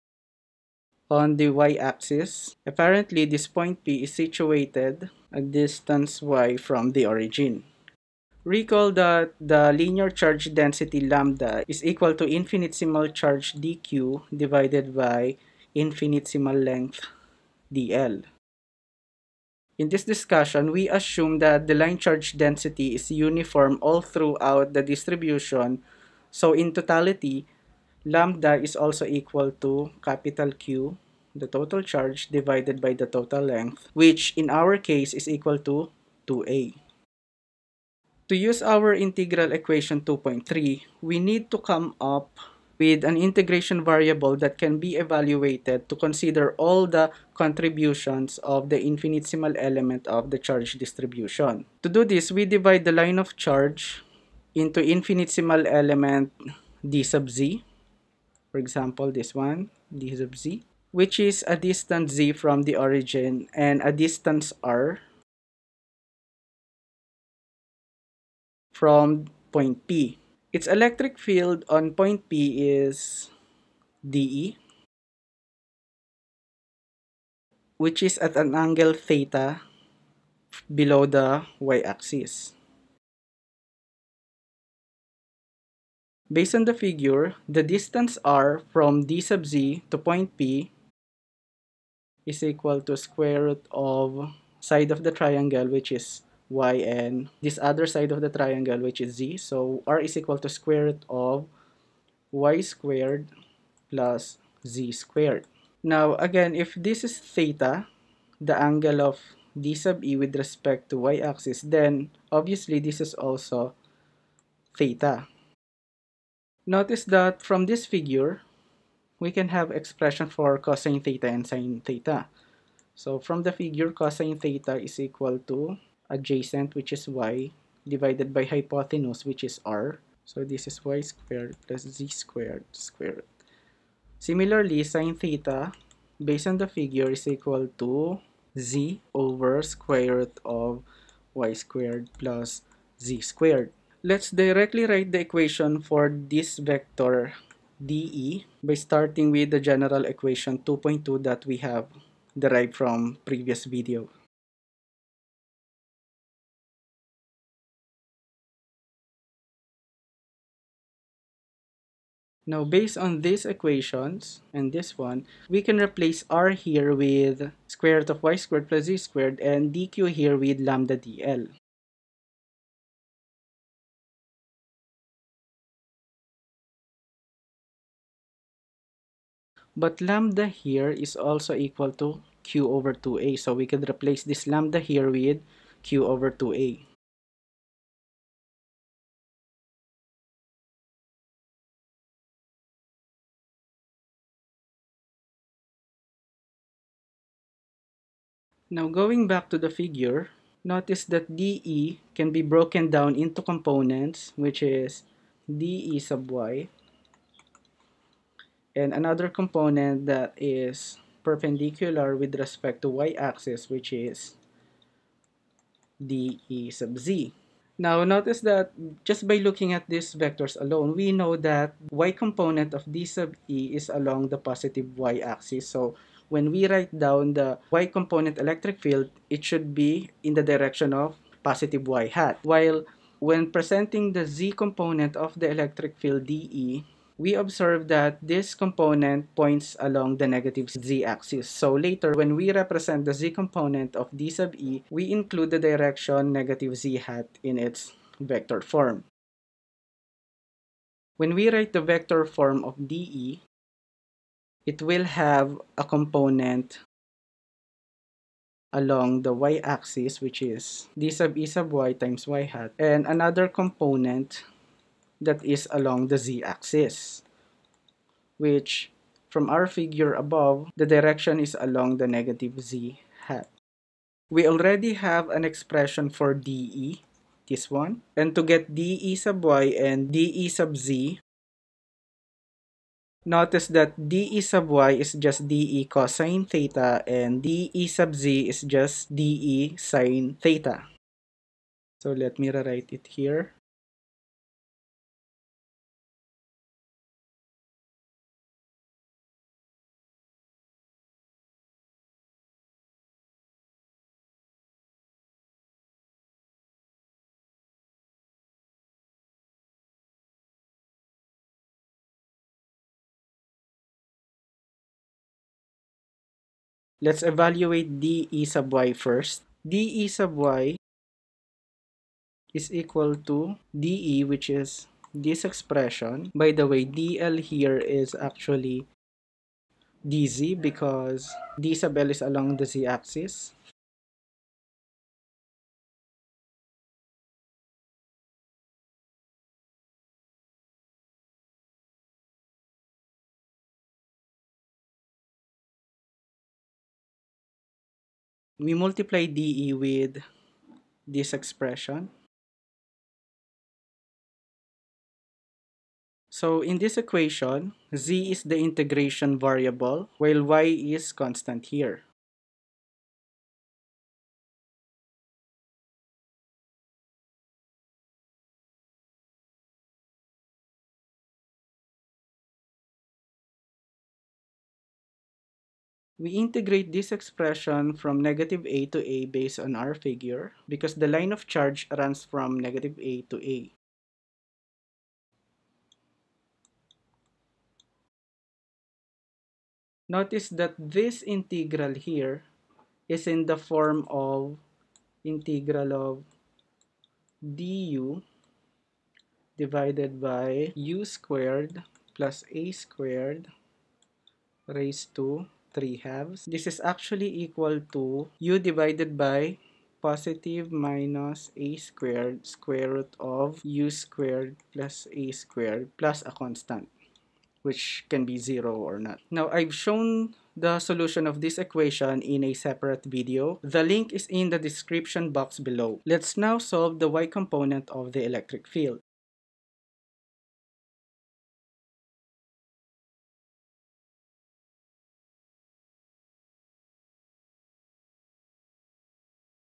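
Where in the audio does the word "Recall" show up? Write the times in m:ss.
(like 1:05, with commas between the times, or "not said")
0:08.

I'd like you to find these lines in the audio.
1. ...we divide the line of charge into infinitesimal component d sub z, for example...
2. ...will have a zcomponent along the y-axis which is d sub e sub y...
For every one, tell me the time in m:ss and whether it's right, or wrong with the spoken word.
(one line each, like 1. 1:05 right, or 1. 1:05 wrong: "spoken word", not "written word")
1. 0:52 wrong: "element", not "component"
2. 4:14 wrong: "component", not "zcomponent".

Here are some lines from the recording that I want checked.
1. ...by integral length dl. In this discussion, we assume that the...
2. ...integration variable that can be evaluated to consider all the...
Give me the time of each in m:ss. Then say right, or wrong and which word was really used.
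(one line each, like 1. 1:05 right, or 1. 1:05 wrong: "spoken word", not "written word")
1. 0:14 wrong: "infinitesimal", not "integral"
2. 0:43 right.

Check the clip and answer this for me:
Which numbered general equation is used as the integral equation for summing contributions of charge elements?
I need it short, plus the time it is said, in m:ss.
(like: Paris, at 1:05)
2.3, at 0:40.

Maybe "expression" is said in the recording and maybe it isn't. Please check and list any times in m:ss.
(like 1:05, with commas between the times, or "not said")
1:59, 4:35, 5:25, 5:51, 6:17.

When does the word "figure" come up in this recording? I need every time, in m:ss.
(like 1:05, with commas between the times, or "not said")
1:26, 1:57, 2:03, 2:16, 3:19, 4:29, 6:19.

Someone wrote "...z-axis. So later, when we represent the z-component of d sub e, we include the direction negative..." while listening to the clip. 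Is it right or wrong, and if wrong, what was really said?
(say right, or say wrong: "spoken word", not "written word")
right.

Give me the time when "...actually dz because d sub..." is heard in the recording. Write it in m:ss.
5:28.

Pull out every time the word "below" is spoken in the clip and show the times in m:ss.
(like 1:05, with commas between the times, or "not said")
1:20, 7:05.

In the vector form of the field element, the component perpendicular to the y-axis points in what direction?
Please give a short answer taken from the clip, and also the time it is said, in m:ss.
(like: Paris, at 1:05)
negative z hat, at 4:32.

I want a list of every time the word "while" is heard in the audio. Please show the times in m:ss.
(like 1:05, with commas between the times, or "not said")
3:52, 6:00.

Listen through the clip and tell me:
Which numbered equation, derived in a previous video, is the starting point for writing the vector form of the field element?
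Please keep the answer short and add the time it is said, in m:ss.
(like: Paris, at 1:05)
2.2, at 2:30.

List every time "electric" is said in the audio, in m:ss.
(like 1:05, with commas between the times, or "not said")
1:10, 3:48, 3:55, 7:08.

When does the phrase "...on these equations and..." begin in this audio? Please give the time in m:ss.
2:42.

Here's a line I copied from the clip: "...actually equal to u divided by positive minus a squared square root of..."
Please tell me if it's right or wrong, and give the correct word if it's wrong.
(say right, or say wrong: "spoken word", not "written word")
right.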